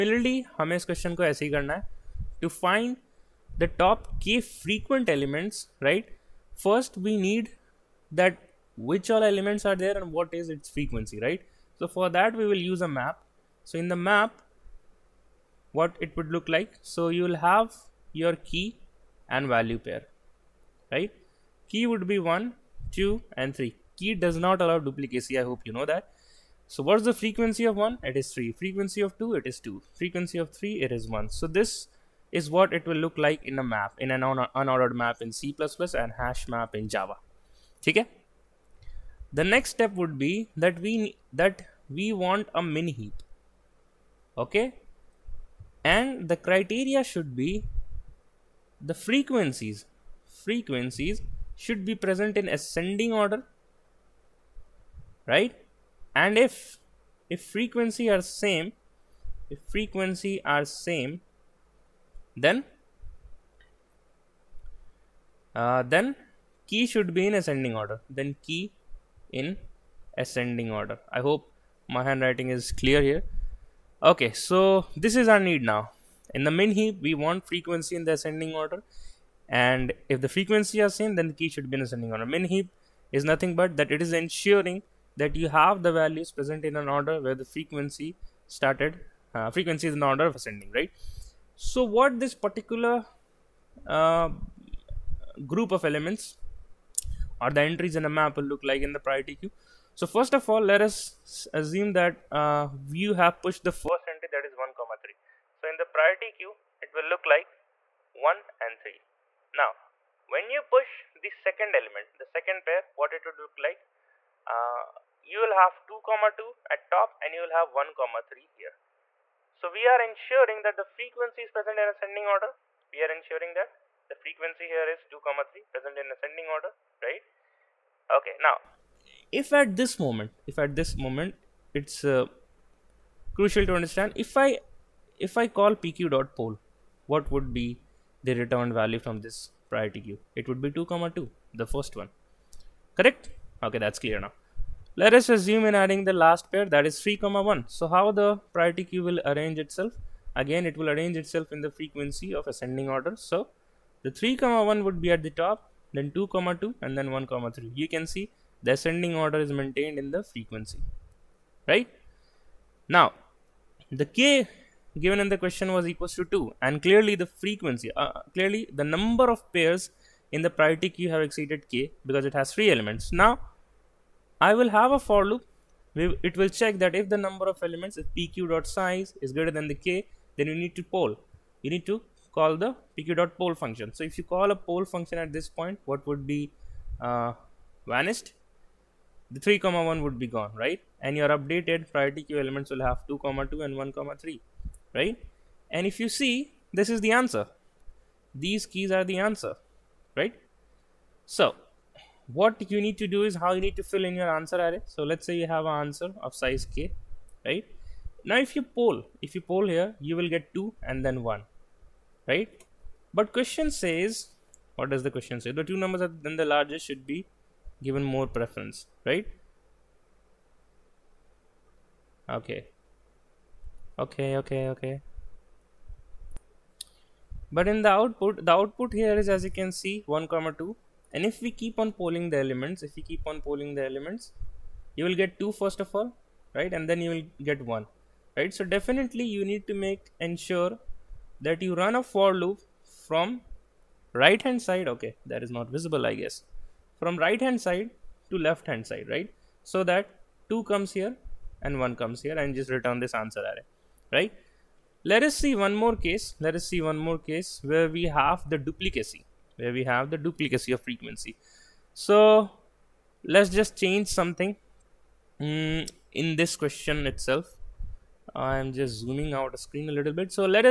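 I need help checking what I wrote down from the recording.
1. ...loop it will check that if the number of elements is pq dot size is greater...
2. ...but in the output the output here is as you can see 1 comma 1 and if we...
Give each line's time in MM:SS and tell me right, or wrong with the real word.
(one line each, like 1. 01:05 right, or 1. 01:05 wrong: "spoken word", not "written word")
1. 02:55 right
2. 03:47 wrong: "2", not "1".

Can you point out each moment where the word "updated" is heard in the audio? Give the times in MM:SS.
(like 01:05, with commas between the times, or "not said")
03:11.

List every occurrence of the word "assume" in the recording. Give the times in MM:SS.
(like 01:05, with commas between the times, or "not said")
01:41, 02:25.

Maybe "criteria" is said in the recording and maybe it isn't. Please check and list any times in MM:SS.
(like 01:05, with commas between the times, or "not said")
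00:46.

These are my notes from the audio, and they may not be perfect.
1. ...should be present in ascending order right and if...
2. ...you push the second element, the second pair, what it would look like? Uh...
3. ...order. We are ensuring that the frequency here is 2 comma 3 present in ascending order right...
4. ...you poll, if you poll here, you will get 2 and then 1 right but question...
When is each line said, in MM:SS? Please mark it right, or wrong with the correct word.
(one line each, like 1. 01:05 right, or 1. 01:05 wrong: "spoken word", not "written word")
1. 00:51 right
2. 01:50 right
3. 02:02 right
4. 03:28 right.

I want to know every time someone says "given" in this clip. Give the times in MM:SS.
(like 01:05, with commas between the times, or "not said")
02:45, 03:37.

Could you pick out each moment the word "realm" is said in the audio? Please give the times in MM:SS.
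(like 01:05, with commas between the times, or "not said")
not said.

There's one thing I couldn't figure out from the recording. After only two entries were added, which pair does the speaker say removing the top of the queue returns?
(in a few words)
2 comma 2.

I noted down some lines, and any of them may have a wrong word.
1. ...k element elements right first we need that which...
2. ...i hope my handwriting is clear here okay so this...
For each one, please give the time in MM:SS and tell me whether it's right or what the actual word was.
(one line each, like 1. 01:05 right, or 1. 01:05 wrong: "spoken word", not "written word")
1. 00:04 wrong: "frequent", not "element"
2. 01:11 right.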